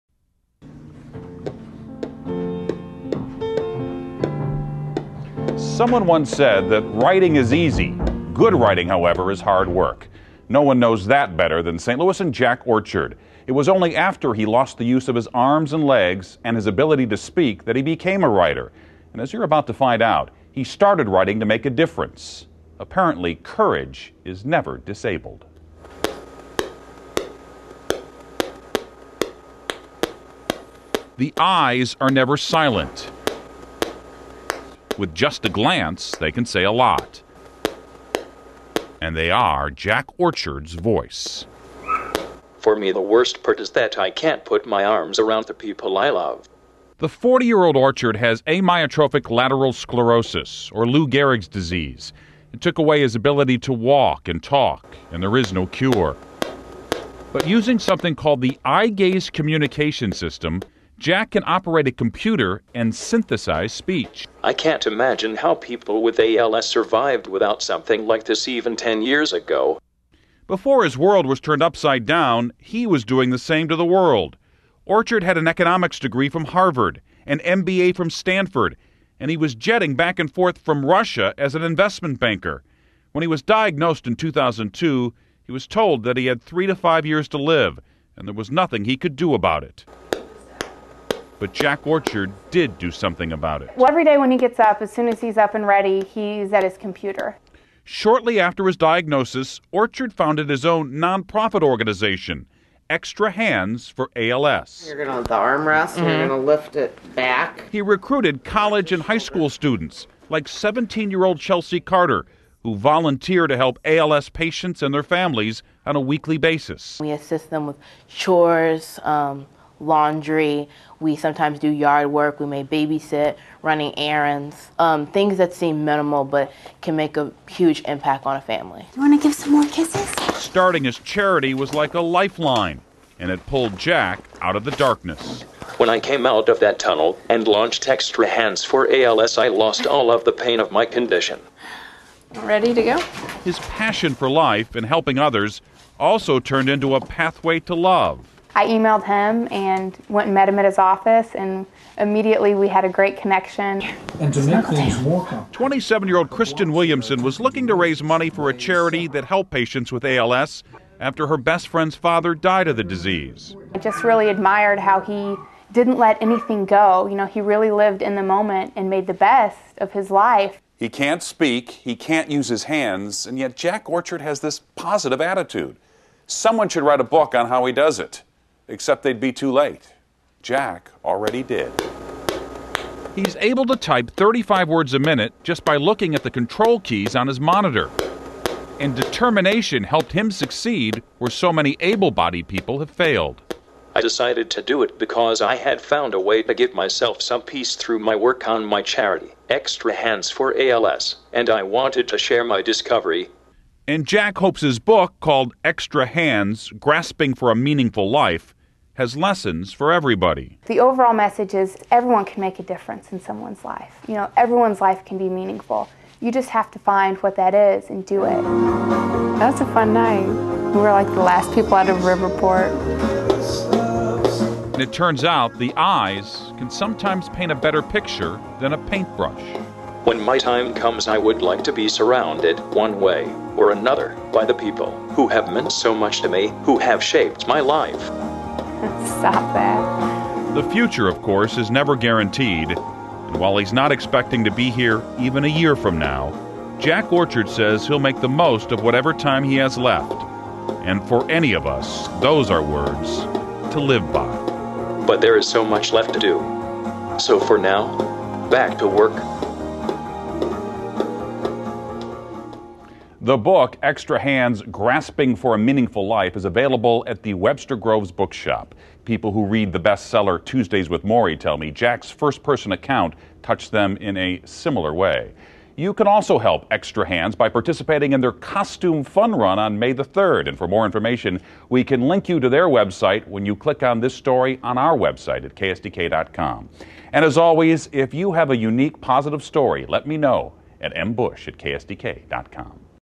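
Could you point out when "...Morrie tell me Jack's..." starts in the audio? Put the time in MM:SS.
04:31.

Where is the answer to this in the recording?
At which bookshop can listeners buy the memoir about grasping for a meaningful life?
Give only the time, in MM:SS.
04:27.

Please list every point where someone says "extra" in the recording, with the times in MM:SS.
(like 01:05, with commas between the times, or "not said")
01:42, 02:17, 03:19, 03:25, 04:23, 04:36.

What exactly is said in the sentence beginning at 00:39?
And they are Jack Orchard's voice.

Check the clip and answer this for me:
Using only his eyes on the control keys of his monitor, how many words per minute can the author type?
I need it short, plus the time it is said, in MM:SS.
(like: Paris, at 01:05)
35, at 03:04.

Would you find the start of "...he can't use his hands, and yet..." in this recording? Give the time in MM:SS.
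02:51.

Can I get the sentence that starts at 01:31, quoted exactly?
But Jack Orchard did do something about it.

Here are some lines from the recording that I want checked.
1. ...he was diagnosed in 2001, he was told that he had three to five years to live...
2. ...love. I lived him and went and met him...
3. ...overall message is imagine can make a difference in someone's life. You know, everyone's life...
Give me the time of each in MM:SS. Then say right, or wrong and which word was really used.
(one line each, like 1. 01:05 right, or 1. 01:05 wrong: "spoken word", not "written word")
1. 01:23 wrong: "2002", not "2001"
2. 02:27 wrong: "emailed", not "lived"
3. 03:30 wrong: "everyone", not "imagine".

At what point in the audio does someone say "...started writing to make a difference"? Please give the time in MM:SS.
00:20.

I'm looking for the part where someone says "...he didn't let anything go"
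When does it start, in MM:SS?
02:44.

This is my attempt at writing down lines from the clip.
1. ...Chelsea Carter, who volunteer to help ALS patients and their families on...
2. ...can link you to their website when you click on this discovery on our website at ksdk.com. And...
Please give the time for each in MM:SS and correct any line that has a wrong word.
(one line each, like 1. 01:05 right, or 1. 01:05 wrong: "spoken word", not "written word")
1. 01:51 right
2. 04:41 wrong: "story", not "discovery".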